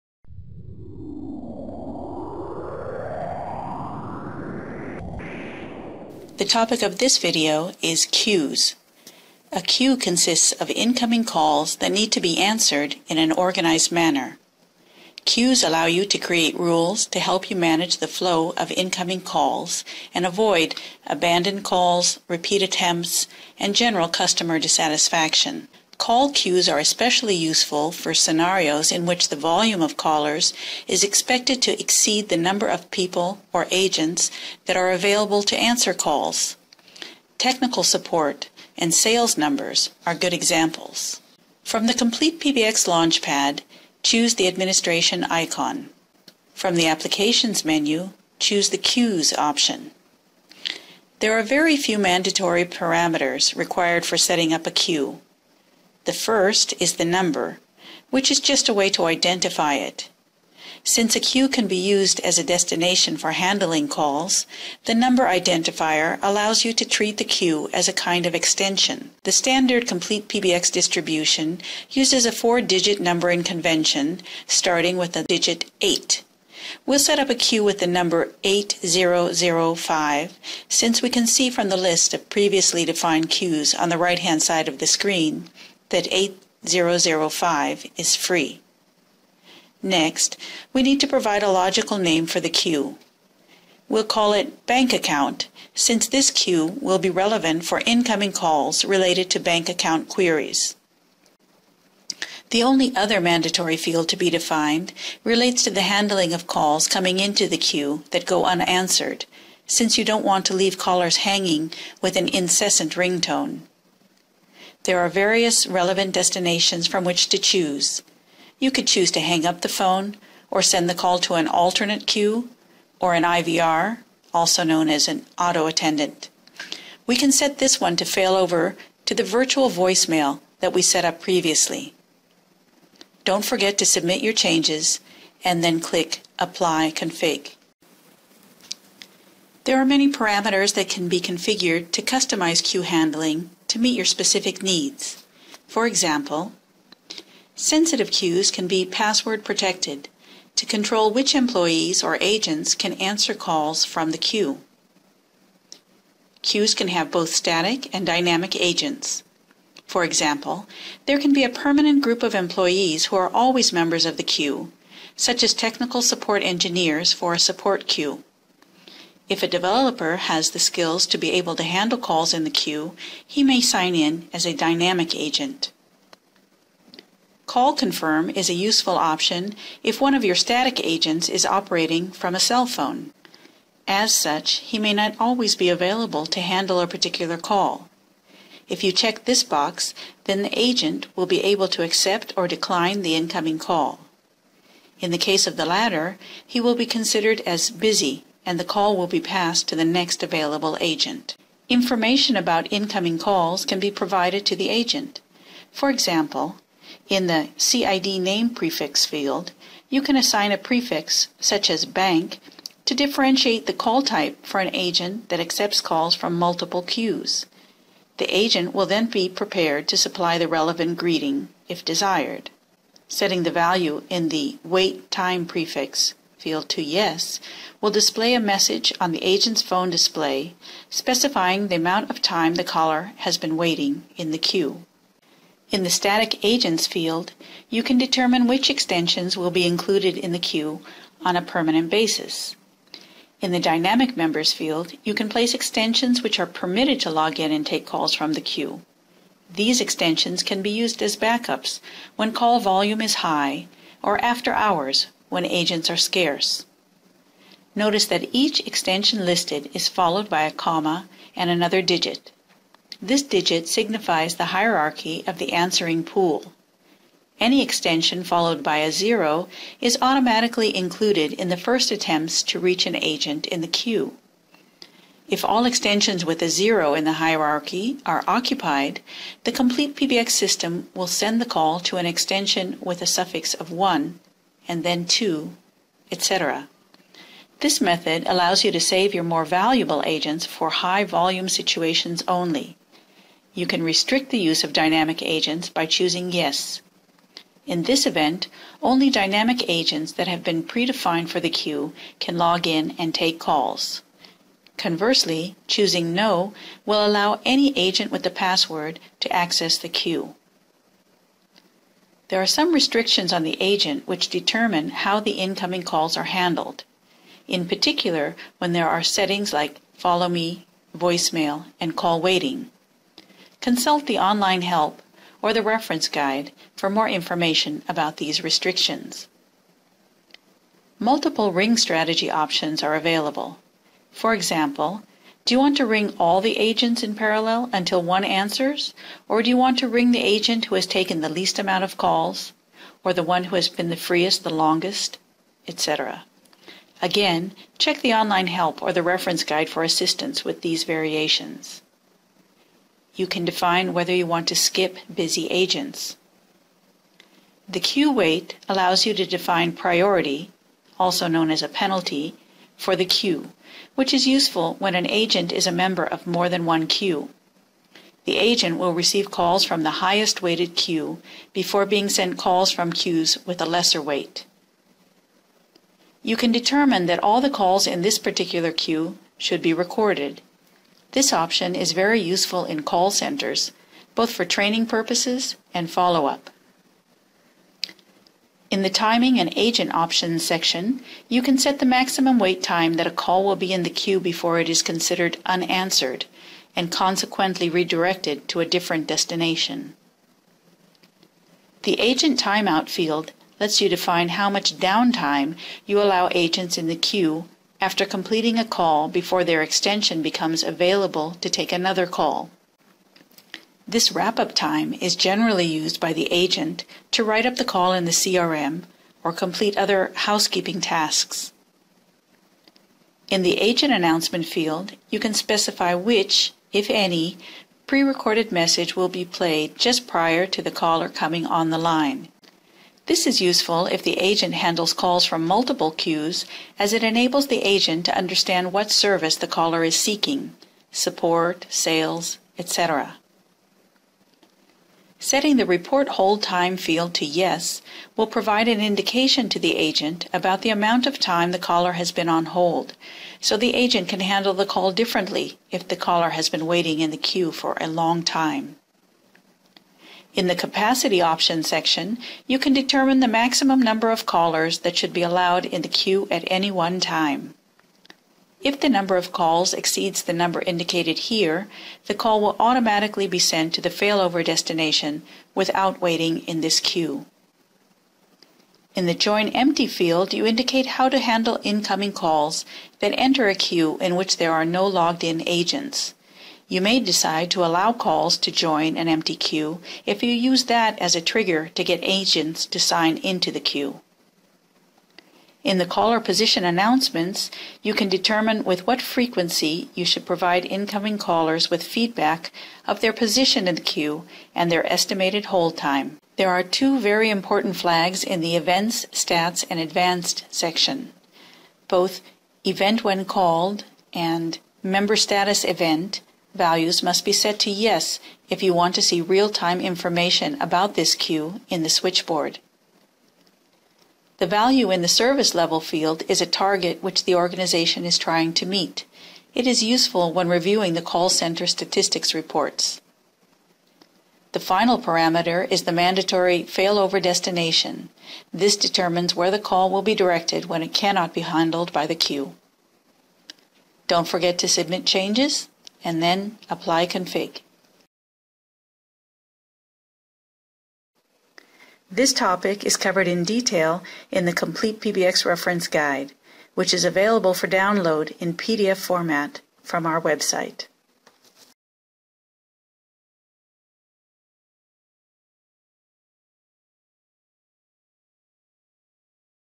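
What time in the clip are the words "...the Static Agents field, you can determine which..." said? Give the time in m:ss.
3:55.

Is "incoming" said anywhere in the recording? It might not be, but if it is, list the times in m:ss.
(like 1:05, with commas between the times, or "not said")
0:10, 0:18, 1:37, 3:13, 3:22, 5:15, 8:01, 8:20.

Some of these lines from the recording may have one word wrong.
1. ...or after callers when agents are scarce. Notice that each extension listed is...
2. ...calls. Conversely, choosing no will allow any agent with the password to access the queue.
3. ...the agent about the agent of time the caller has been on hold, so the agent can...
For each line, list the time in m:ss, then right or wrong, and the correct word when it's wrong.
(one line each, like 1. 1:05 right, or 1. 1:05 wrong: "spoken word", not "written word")
1. 4:14 wrong: "hours", not "callers"
2. 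5:03 right
3. 7:29 wrong: "amount", not "agent".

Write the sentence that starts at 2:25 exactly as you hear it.
For example, sensitive queues can be password protected to control which employees or agents can answer calls from the queue.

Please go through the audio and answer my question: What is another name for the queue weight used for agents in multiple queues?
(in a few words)
penalty.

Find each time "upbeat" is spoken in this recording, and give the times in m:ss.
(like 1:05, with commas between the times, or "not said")
not said.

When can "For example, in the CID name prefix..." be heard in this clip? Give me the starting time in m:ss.
3:25.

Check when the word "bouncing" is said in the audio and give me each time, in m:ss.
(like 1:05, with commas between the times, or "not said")
not said.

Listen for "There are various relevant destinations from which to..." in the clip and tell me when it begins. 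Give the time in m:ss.
1:54.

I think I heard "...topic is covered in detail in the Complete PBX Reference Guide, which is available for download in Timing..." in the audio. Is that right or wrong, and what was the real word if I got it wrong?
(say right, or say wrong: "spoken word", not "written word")
wrong: "PDF", not "Timing".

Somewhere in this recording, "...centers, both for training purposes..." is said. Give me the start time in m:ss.
6:23.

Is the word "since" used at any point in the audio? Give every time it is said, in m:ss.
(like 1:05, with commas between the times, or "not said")
1:00, 1:20, 1:35, 1:49.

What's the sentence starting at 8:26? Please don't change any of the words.
There are two very important flags in the Events, Stats, and Advanced section.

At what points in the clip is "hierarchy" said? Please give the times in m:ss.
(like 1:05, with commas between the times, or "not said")
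4:24, 4:37.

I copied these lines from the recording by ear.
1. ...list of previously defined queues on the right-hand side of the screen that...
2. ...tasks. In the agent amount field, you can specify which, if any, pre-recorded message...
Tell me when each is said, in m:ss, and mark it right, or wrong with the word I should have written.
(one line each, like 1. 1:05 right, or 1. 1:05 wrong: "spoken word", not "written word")
1. 1:21 right
2. 7:00 wrong: "announcement", not "amount".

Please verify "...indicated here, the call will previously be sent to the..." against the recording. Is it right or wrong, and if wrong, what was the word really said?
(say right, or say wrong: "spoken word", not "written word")
wrong: "automatically", not "previously".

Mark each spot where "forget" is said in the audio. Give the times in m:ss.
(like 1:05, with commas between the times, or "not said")
2:13, 9:04.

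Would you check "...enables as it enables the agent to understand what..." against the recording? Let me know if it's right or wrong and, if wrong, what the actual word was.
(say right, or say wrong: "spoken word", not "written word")
wrong: "queues", not "enables".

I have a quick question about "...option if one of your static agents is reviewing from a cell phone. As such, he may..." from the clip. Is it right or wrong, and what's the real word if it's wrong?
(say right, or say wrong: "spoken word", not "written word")
wrong: "operating", not "reviewing".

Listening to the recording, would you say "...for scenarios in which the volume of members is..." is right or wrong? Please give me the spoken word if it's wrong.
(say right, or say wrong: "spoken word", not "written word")
wrong: "callers", not "members".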